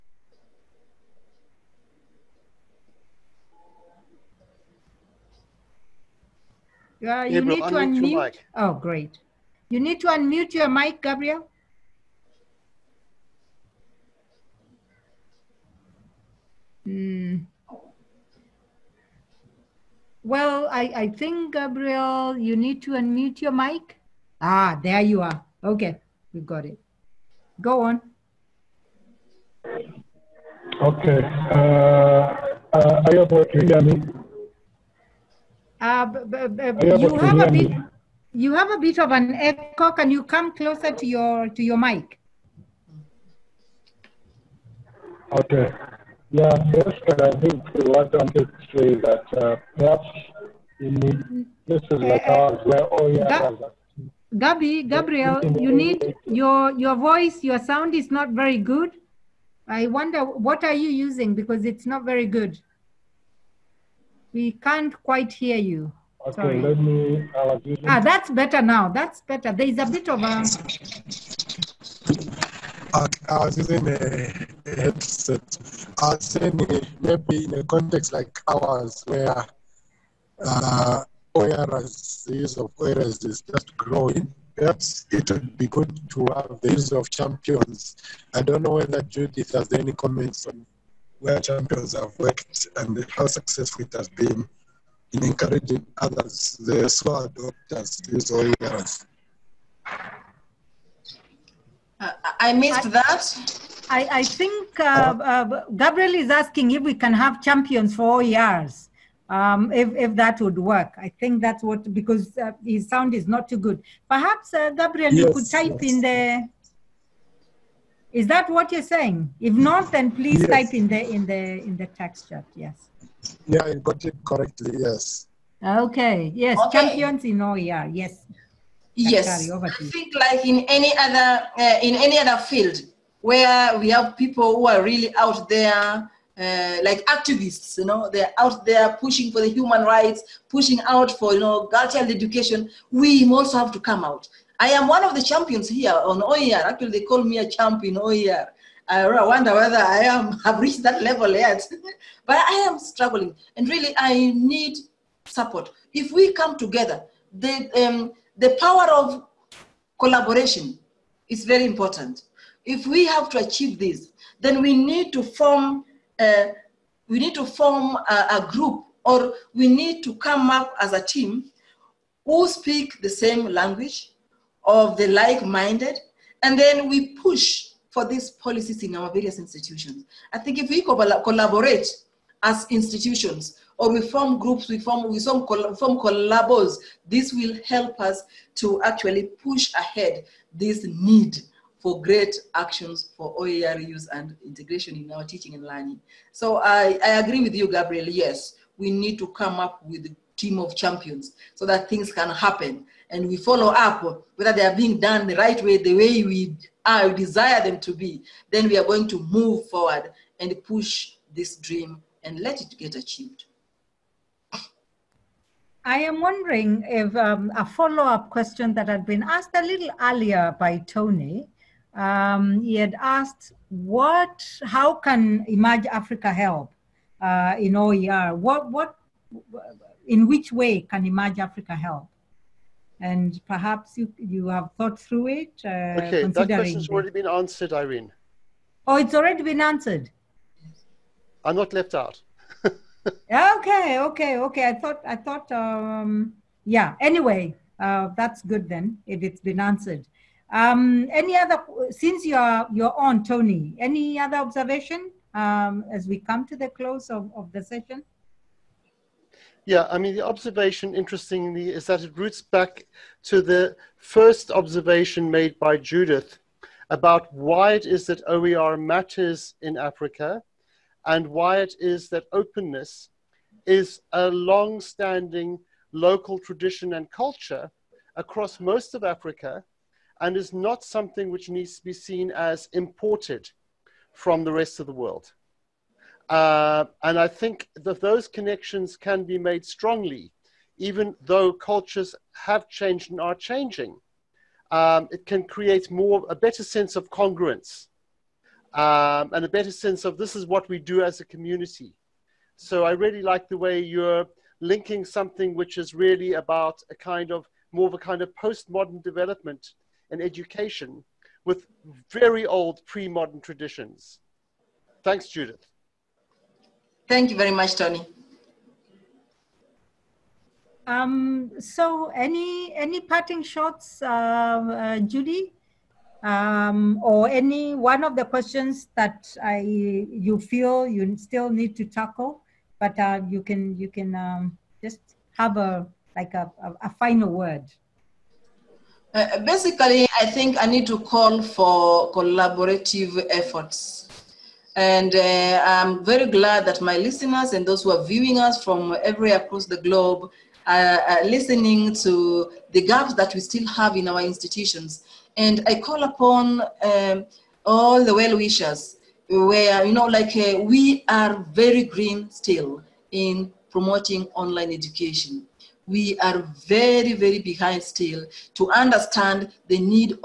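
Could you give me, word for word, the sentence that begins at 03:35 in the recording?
I am wondering if um, a follow up question that had been asked a little earlier by Tony.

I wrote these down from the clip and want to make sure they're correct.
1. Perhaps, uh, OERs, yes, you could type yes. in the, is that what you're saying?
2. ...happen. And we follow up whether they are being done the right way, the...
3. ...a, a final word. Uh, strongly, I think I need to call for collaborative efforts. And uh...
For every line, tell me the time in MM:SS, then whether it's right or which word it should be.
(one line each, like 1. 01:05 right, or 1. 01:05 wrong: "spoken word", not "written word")
1. 01:54 wrong: "Gabriel", not "OERs"
2. 03:22 right
3. 05:36 wrong: "basically", not "strongly".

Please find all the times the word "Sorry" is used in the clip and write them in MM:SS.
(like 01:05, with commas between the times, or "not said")
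01:06.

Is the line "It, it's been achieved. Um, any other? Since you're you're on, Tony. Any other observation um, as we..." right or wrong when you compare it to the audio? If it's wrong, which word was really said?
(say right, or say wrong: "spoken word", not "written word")
wrong: "answered", not "achieved".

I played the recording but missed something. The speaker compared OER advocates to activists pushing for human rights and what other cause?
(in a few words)
girl-child education.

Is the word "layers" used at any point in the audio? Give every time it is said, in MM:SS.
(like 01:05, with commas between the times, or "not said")
not said.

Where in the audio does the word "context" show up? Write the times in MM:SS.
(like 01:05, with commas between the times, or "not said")
01:17.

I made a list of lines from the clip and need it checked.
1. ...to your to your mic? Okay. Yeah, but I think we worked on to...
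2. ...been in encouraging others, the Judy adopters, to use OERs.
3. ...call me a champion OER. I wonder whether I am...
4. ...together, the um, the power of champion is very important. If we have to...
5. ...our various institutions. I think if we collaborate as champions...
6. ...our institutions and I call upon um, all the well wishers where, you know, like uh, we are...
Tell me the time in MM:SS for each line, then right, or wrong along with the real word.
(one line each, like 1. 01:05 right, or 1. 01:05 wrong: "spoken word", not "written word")
1. 00:40 right
2. 01:34 wrong: "SWA", not "Judy"
3. 02:27 right
4. 02:36 wrong: "collaboration", not "champion"
5. 02:58 wrong: "institutions", not "champions"
6. 05:54 right.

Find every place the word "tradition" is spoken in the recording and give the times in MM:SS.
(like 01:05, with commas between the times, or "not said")
04:36, 05:13.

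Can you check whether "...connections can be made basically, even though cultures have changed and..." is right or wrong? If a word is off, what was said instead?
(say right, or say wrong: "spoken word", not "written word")
wrong: "strongly", not "basically".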